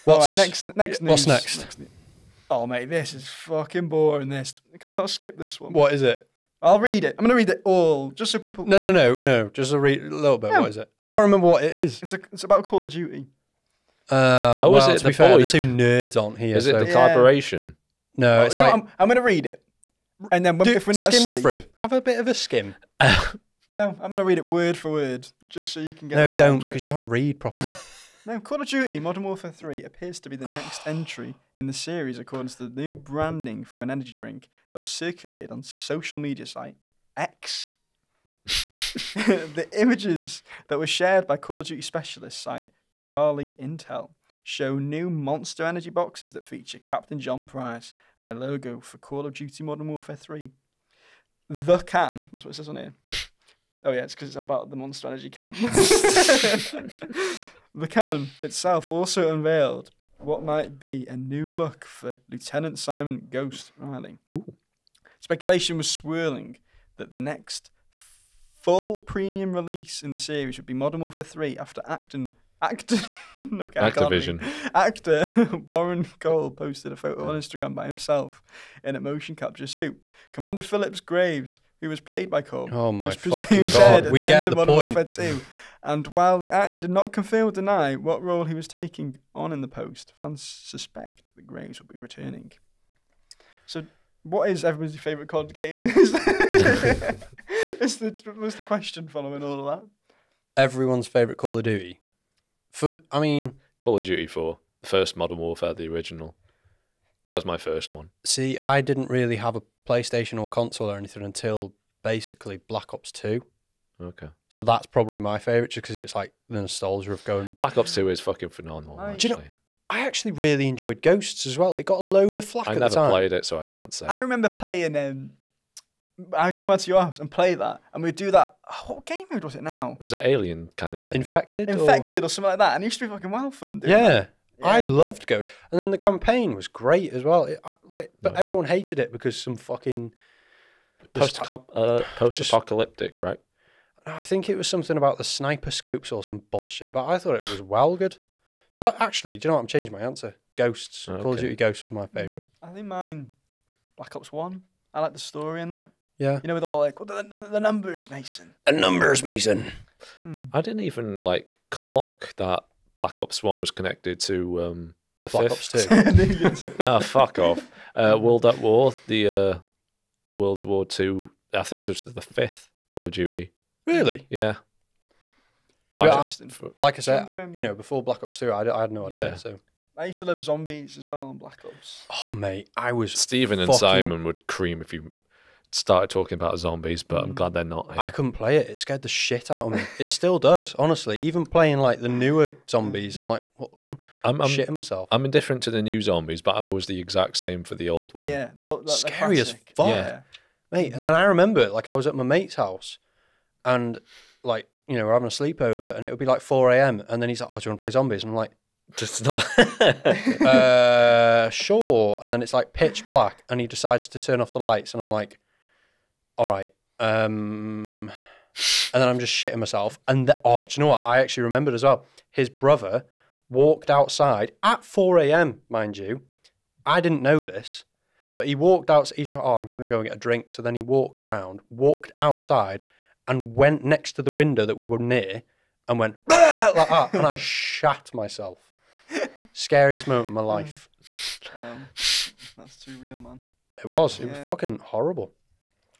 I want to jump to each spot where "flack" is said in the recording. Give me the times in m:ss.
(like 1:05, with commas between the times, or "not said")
2:02.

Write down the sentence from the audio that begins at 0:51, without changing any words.
The can, that's what it says on here.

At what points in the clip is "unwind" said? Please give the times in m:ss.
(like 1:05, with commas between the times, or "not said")
not said.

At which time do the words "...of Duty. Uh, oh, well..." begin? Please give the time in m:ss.
0:12.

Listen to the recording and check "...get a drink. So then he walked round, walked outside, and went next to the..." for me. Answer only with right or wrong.
right.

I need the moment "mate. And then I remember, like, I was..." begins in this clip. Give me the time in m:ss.
3:20.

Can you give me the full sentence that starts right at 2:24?
I think it was something about the sniper scopes or some bullshit, but I thought it was well good.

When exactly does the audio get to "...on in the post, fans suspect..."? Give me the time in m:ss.
1:29.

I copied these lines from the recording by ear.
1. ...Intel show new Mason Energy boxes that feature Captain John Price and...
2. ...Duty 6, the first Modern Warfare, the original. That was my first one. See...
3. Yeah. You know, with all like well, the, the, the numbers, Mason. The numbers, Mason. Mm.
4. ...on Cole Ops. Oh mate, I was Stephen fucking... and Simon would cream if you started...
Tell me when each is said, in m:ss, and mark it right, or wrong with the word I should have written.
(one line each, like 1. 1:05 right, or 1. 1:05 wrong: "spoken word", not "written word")
1. 0:43 wrong: "Monster", not "Mason"
2. 1:44 wrong: "4", not "6"
3. 2:36 right
4. 3:01 wrong: "Black", not "Cole".